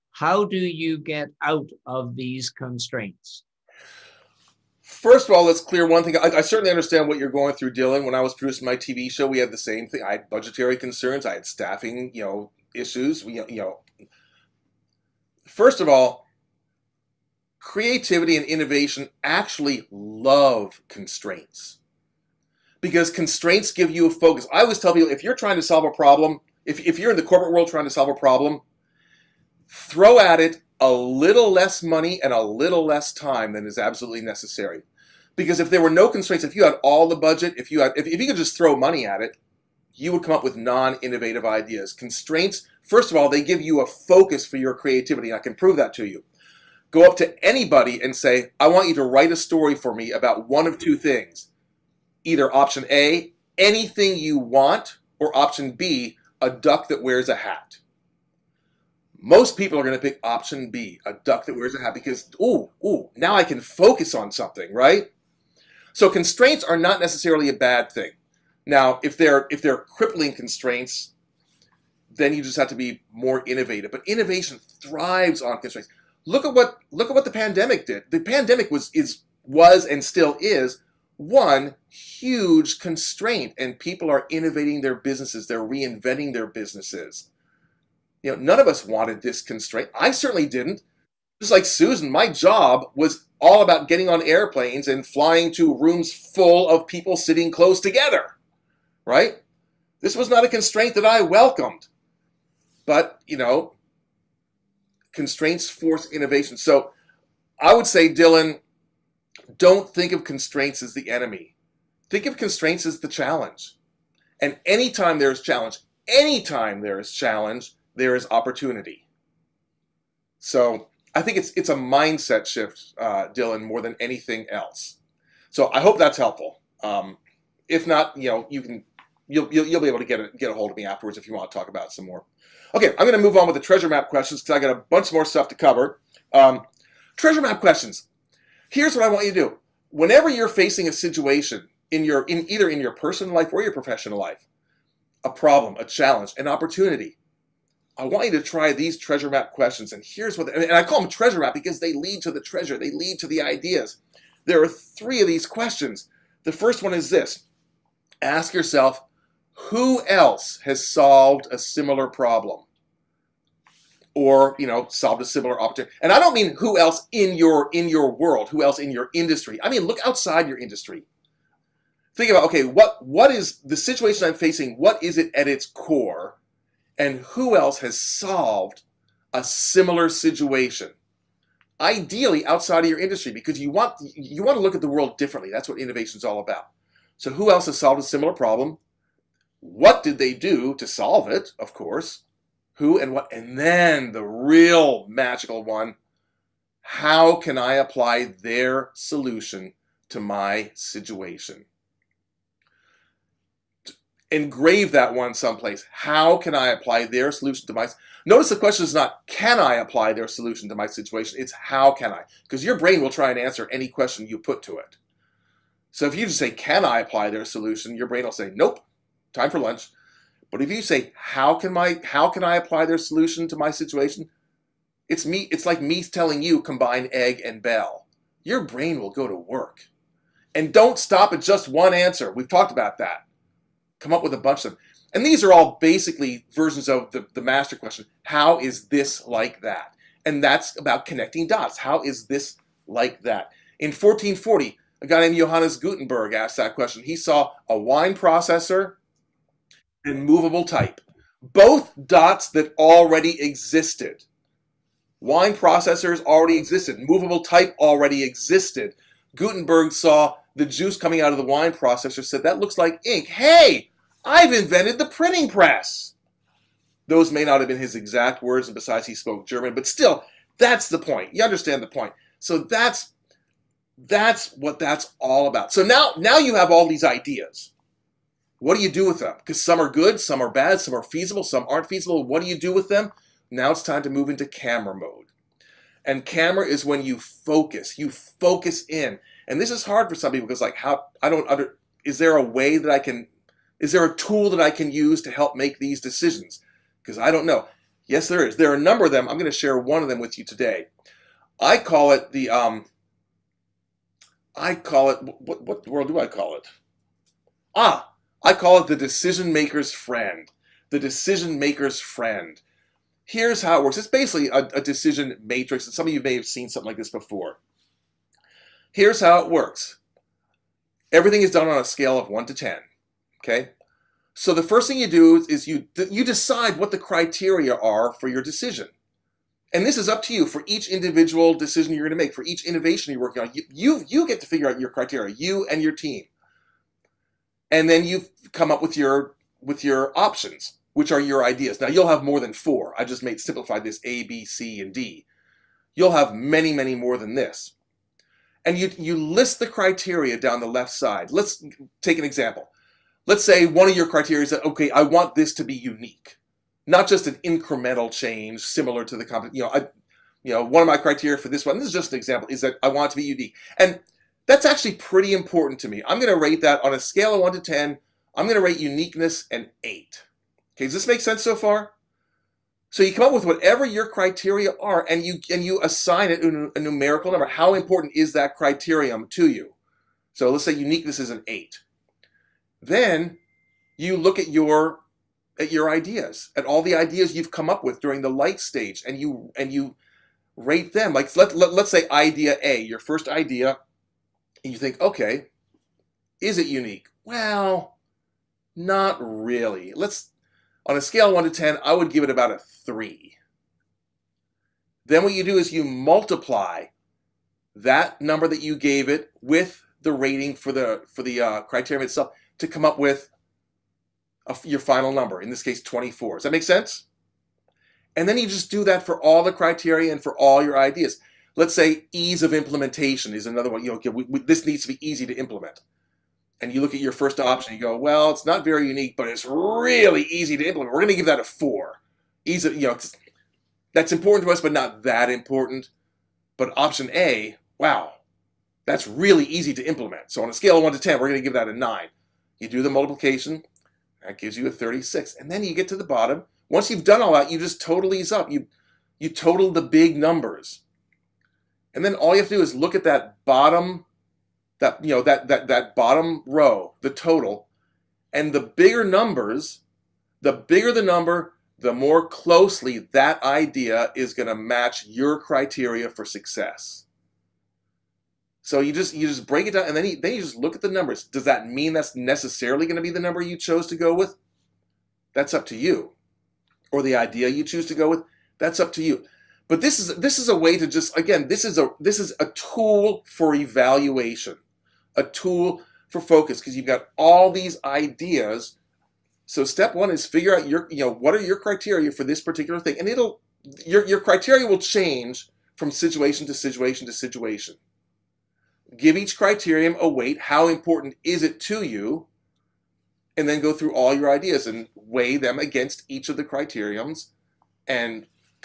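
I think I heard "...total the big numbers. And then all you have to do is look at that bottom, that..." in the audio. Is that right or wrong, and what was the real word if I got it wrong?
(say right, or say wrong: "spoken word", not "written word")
right.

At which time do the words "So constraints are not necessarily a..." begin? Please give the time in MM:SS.
01:05.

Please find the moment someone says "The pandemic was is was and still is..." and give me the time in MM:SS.
01:18.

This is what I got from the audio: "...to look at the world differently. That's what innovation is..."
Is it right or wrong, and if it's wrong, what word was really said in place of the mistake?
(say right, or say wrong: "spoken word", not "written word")
right.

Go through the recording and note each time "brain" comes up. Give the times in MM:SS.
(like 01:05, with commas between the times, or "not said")
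03:32, 03:38, 03:48.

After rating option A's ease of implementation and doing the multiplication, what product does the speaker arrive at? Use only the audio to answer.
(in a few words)
36.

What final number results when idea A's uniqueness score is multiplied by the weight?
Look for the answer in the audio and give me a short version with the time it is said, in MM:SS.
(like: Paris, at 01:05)
24, at 06:55.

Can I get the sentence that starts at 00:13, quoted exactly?
We, you know, first of all, creativity and innovation actually love constraints because constraints give you a focus.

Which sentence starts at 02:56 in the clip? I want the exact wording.
And who else has solved a similar situation?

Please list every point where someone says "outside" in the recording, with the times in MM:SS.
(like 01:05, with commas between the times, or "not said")
02:50, 03:02.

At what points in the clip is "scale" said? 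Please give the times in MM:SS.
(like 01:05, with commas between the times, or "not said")
05:21, 06:06, 06:41, 07:20.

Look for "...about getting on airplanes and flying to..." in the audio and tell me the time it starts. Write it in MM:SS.
01:33.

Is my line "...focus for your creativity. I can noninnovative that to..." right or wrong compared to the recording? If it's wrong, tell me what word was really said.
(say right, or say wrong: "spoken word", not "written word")
wrong: "prove", not "noninnovative".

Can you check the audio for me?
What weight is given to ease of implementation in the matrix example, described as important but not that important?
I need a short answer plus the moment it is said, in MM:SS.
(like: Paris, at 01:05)
4, at 07:11.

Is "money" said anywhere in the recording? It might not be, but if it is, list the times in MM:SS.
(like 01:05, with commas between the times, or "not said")
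00:31, 00:38.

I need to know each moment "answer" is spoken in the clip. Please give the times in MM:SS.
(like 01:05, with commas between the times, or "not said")
03:33, 03:51.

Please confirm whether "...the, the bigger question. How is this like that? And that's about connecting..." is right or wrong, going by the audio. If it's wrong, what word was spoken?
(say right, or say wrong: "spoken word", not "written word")
wrong: "master", not "bigger".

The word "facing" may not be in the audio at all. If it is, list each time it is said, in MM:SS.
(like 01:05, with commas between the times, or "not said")
02:20, 02:54.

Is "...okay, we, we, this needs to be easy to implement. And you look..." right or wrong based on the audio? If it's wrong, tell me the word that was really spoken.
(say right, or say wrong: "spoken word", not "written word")
right.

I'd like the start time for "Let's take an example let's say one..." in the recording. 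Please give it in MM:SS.
05:51.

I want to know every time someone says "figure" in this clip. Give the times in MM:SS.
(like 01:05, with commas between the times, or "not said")
05:34, 08:10.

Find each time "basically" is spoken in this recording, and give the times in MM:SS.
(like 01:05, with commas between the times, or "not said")
03:55, 05:14.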